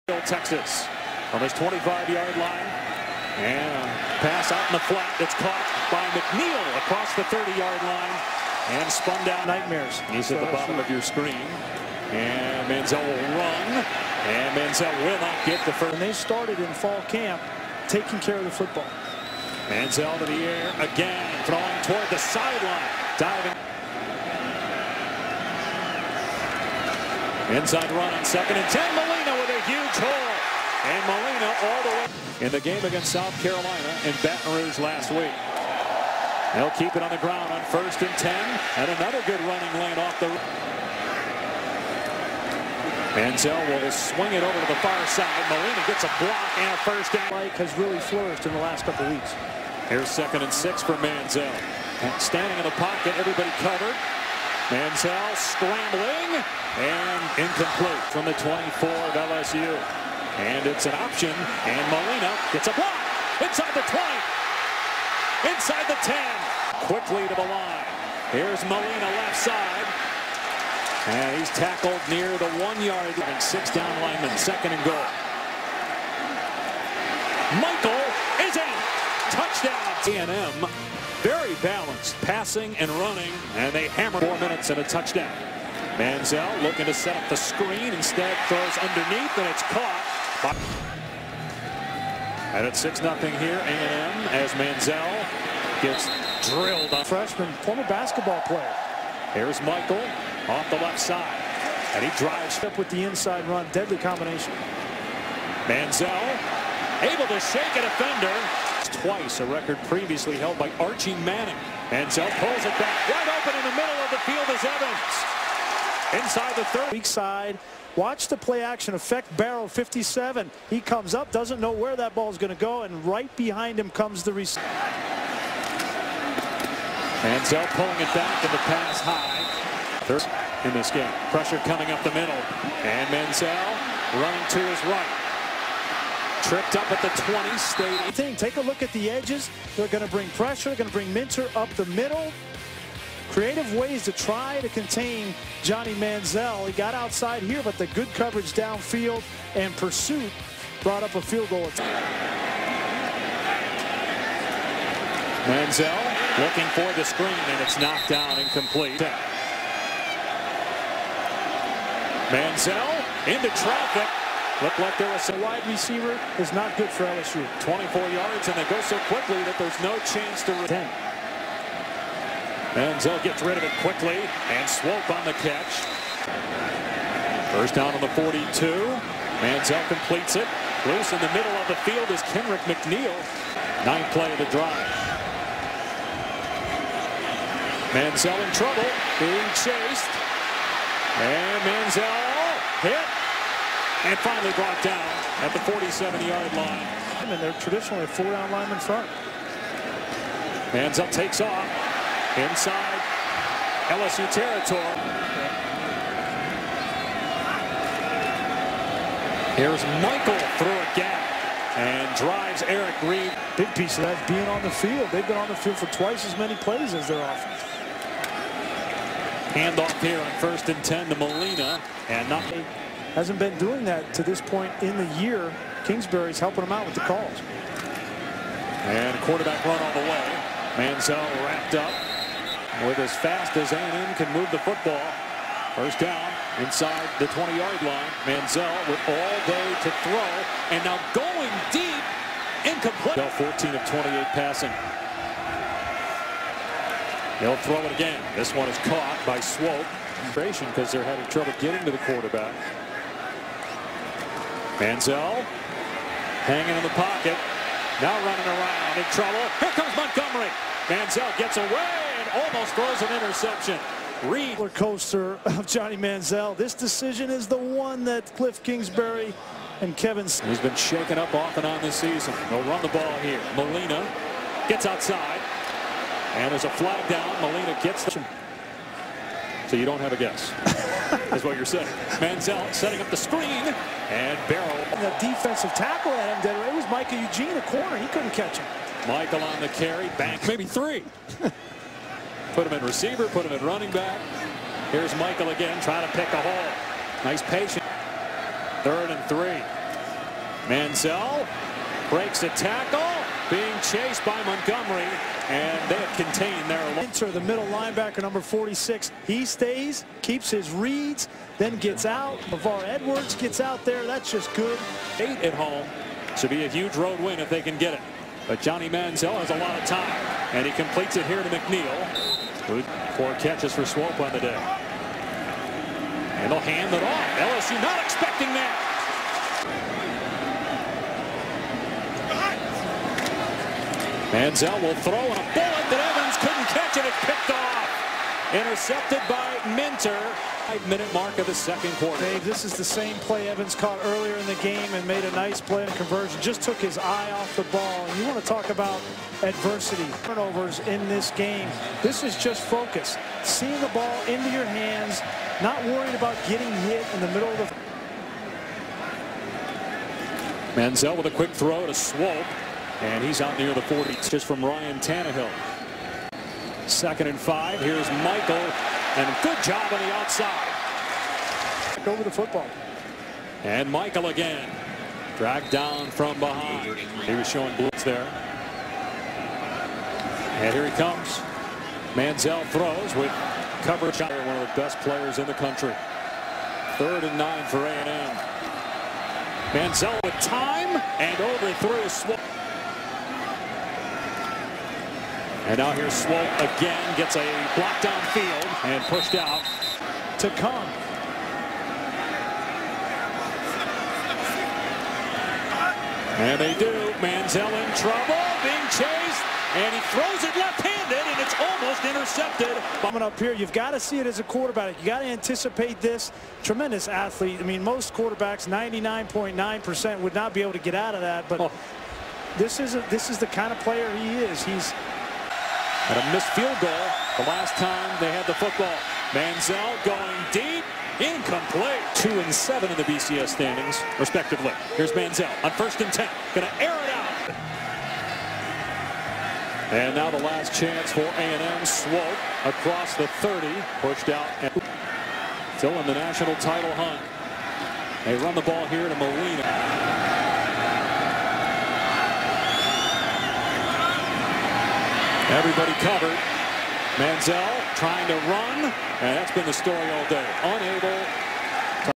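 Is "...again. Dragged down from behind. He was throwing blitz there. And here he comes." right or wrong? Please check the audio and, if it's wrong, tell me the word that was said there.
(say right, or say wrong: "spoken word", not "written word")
wrong: "showing", not "throwing".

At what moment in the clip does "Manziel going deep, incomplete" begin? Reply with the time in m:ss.
7:09.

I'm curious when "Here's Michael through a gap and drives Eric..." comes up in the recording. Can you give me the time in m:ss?
3:29.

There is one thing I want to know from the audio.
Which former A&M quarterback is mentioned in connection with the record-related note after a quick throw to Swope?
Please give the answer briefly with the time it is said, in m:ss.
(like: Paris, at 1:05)
Ryan Tannehill, at 6:04.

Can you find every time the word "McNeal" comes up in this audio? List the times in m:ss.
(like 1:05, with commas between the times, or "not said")
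0:06, 3:02, 5:21.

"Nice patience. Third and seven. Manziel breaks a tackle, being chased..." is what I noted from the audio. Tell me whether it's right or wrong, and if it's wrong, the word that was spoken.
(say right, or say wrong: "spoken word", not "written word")
wrong: "three", not "seven".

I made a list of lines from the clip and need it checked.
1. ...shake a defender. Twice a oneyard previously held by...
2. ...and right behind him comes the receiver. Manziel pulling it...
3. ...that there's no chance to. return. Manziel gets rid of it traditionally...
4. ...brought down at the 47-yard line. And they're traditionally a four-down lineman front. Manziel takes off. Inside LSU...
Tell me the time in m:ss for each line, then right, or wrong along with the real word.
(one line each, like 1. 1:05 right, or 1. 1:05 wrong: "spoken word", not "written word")
1. 1:47 wrong: "record", not "oneyard"
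2. 2:02 right
3. 2:49 wrong: "quickly", not "traditionally"
4. 3:14 right.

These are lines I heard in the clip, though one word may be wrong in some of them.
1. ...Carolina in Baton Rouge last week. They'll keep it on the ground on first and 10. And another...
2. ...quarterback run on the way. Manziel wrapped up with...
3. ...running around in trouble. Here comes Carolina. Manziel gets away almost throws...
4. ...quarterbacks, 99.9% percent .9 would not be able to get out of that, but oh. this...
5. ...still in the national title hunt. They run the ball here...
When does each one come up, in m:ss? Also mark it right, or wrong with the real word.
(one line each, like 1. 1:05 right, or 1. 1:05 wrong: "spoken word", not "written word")
1. 0:33 right
2. 3:49 right
3. 4:18 wrong: "Montgomery", not "Carolina"
4. 6:58 right
5. 7:25 right.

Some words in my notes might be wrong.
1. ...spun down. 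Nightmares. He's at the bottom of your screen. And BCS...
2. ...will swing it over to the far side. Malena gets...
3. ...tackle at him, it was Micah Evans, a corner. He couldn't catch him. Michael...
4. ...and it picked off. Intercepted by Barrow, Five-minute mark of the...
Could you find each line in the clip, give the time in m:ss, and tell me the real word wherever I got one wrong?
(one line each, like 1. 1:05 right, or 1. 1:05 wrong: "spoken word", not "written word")
1. 0:08 wrong: "Manziel", not "BCS"
2. 0:43 right
3. 4:45 wrong: "Eugene", not "Evans"
4. 5:36 wrong: "Minter", not "Barrow".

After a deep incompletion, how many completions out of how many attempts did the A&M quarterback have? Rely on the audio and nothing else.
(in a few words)
14 of 28.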